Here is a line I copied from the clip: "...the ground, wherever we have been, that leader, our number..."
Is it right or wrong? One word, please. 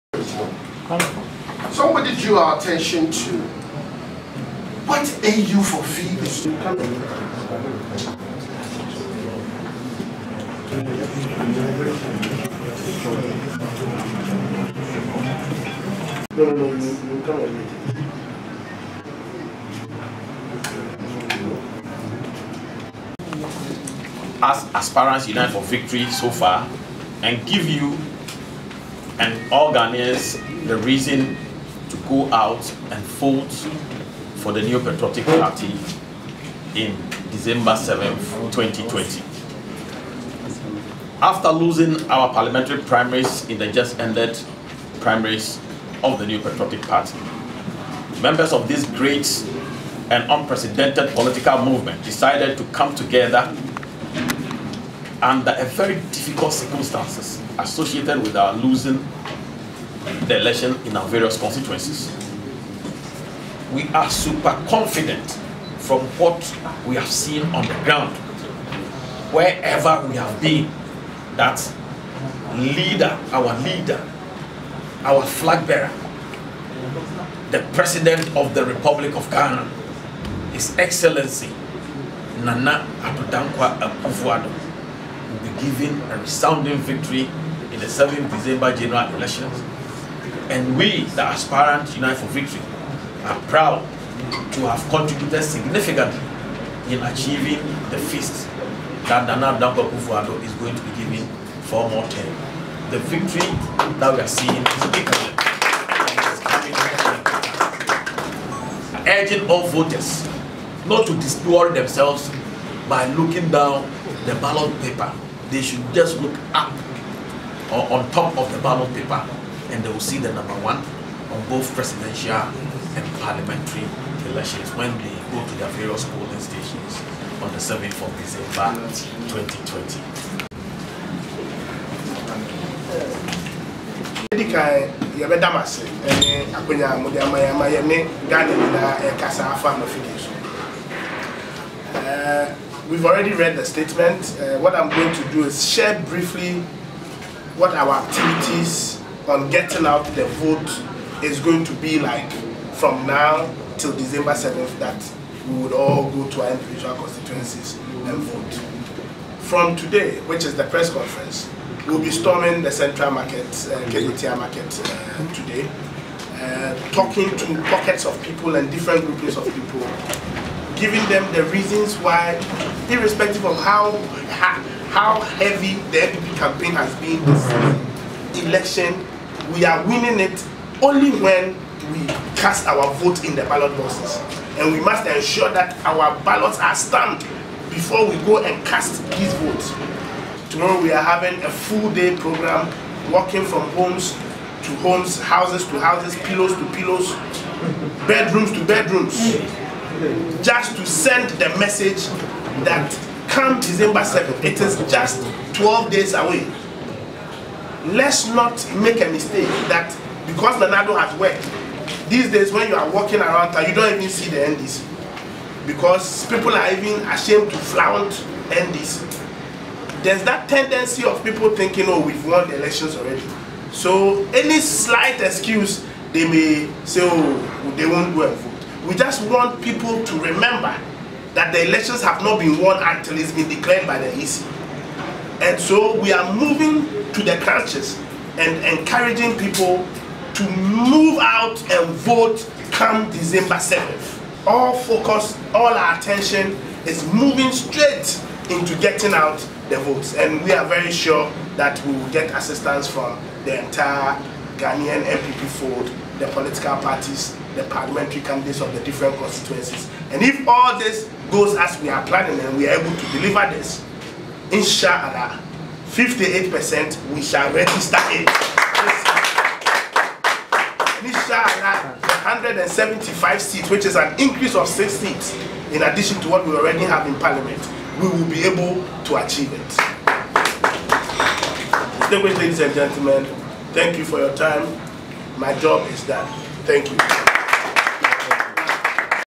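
wrong.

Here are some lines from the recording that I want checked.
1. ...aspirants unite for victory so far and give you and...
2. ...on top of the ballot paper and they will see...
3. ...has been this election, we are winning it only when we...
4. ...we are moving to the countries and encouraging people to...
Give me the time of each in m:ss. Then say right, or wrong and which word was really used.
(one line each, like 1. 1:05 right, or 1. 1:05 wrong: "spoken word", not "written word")
1. 0:24 right
2. 1:57 right
3. 2:56 right
4. 3:56 right.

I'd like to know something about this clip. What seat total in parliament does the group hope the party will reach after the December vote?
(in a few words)
175.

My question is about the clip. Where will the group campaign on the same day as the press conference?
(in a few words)
Central market.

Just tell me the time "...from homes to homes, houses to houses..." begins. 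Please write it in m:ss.
3:13.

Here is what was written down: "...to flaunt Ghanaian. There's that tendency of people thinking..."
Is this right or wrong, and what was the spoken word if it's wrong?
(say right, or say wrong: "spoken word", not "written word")
wrong: "NDC", not "Ghanaian".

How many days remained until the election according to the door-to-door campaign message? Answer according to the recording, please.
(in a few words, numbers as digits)
12.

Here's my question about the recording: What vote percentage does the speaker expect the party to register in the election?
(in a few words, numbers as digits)
58%.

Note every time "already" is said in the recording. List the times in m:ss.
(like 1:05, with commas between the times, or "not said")
2:23, 3:42, 4:36.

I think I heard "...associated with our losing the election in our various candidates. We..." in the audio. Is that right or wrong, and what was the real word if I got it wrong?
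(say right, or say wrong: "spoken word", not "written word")
wrong: "constituencies", not "candidates".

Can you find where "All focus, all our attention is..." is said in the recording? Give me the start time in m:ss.
4:04.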